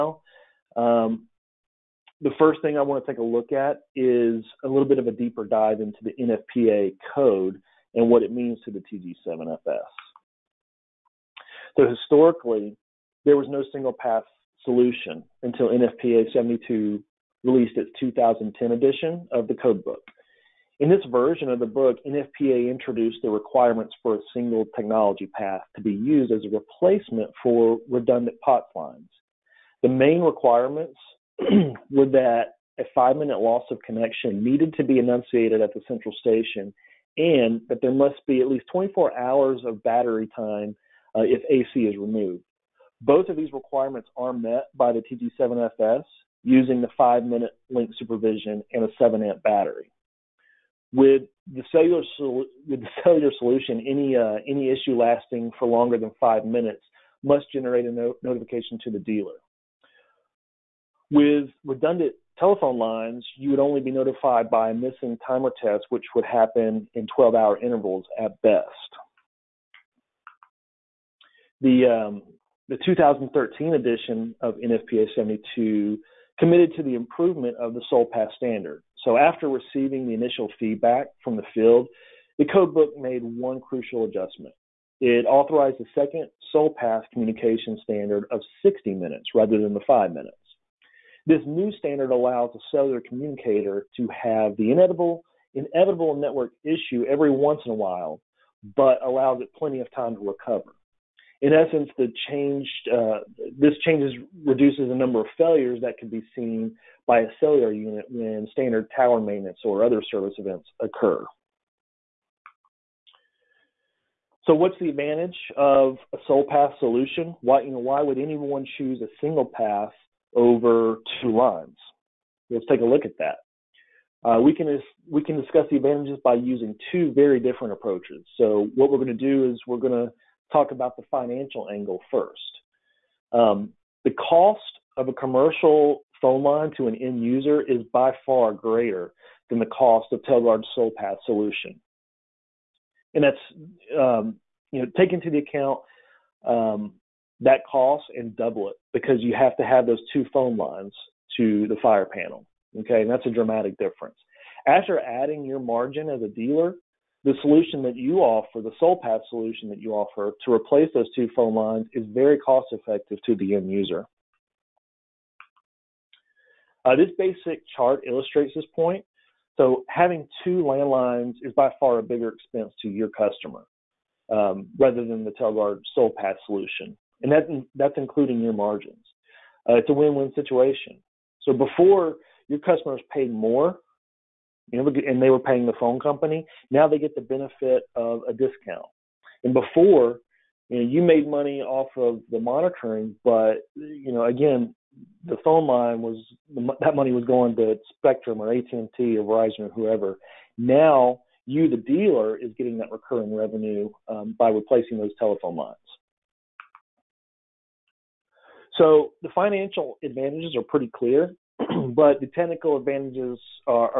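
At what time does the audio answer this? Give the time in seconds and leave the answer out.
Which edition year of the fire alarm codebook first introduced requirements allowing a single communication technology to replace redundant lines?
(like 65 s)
17 s.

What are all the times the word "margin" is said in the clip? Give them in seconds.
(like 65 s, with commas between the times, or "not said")
155 s, 178 s.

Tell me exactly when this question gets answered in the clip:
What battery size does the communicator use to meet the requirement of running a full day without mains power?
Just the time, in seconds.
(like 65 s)
48 s.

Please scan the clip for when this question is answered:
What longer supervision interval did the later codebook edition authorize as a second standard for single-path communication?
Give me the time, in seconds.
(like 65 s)
88 s.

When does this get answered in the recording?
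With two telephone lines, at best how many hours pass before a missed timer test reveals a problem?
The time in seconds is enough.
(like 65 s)
67 s.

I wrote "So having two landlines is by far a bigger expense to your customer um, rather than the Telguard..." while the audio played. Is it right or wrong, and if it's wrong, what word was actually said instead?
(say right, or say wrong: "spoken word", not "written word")
right.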